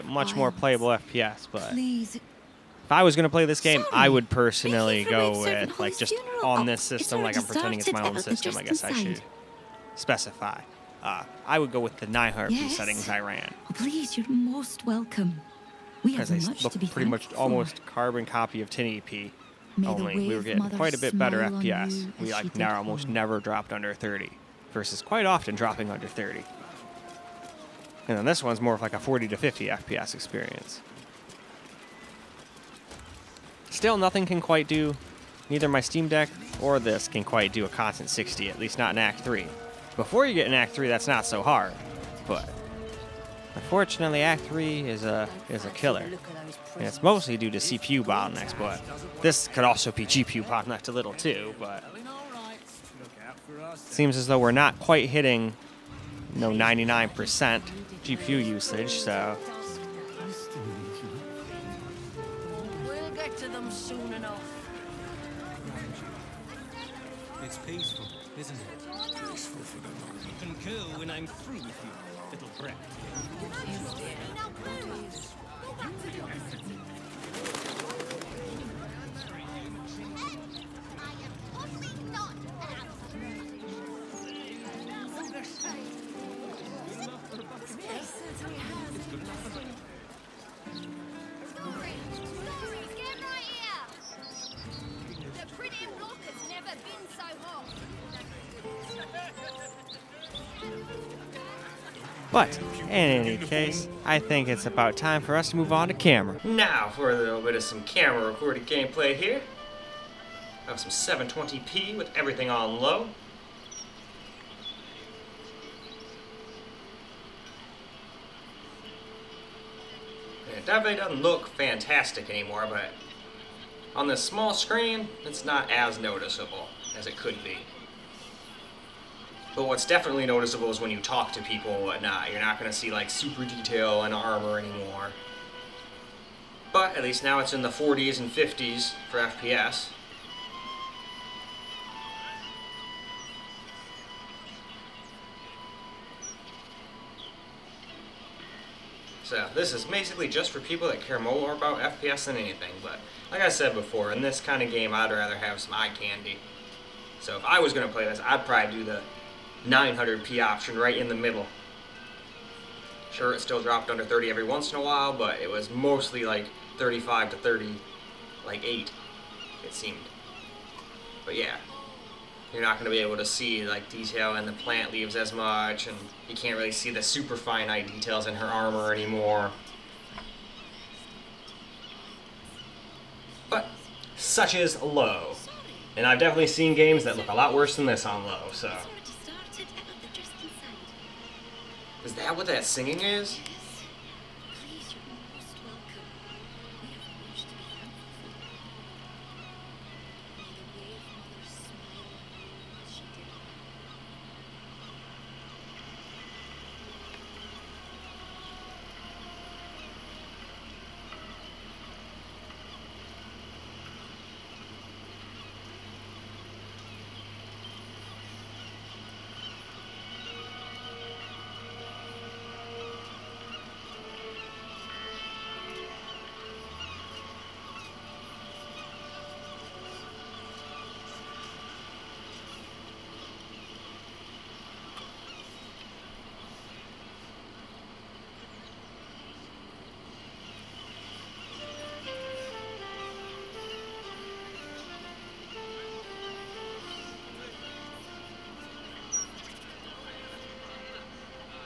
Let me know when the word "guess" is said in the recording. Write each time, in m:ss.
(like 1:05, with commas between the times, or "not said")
0:08.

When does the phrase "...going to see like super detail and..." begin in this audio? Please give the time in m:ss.
2:12.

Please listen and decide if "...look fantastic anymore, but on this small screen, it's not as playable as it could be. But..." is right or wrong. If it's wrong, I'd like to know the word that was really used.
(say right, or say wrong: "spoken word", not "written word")
wrong: "noticeable", not "playable".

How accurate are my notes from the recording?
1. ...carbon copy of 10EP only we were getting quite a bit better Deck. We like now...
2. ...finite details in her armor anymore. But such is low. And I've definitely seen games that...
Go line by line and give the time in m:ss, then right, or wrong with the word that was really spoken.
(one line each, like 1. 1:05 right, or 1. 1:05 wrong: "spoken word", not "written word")
1. 0:17 wrong: "FPS", not "Deck"
2. 2:57 right.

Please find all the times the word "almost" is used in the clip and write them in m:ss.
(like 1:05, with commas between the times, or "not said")
0:17, 0:22.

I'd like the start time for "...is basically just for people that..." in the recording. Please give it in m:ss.
2:29.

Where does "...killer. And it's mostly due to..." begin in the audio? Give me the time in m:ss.
0:45.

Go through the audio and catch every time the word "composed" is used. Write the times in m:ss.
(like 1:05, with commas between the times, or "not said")
not said.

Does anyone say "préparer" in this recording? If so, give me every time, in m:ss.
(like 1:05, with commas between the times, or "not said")
not said.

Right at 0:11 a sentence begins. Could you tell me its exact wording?
Uh, I would go with the Nihar yes.